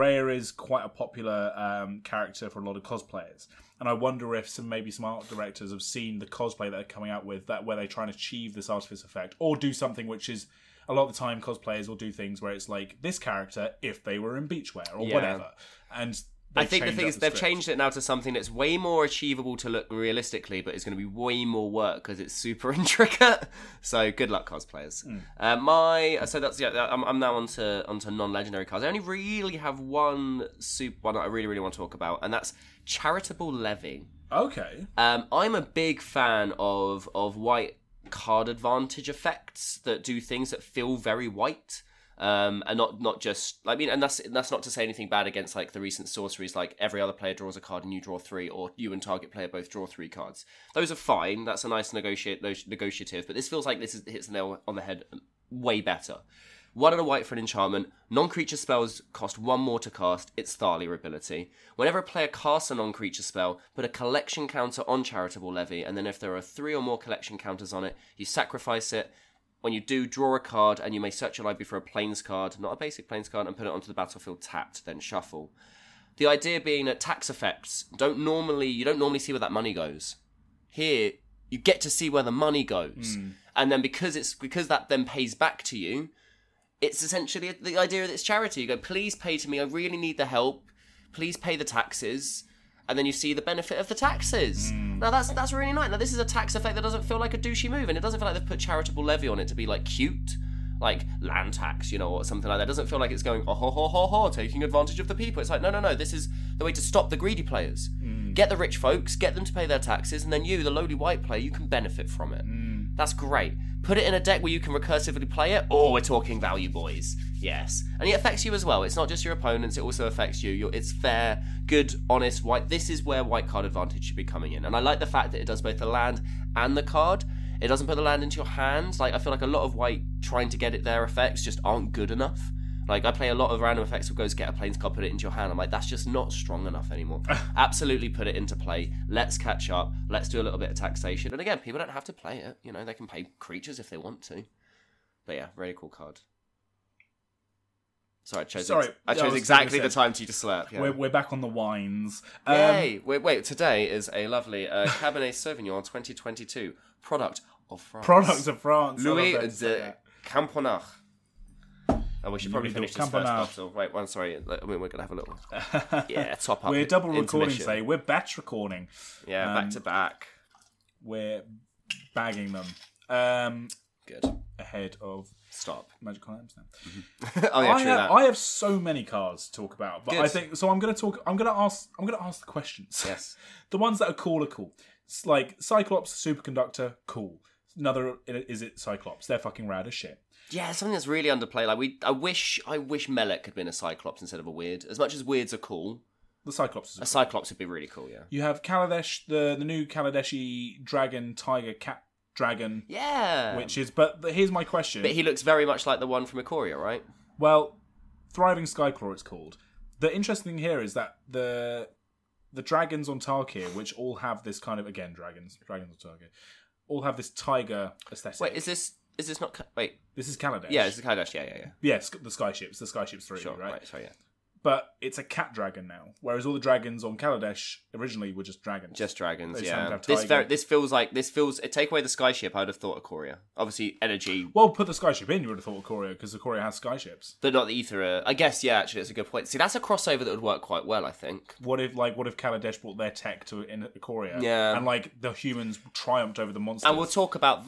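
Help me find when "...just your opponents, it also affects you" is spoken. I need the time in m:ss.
1:59.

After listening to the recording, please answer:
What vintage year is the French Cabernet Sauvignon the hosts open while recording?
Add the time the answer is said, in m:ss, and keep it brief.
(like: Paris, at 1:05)
2022, at 2:35.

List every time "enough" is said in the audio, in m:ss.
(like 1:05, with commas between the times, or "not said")
2:12, 2:16.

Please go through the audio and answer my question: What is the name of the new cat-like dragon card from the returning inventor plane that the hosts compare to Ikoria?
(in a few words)
Thriving Skyclaw.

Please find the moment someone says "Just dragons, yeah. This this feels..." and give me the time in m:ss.
3:48.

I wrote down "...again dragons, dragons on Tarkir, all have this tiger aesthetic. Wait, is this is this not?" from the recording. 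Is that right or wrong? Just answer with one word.
right.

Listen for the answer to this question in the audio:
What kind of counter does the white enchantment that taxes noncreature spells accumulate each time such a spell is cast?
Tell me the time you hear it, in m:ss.
1:03.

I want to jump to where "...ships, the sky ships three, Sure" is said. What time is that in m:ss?
3:42.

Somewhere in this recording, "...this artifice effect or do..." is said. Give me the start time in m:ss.
0:08.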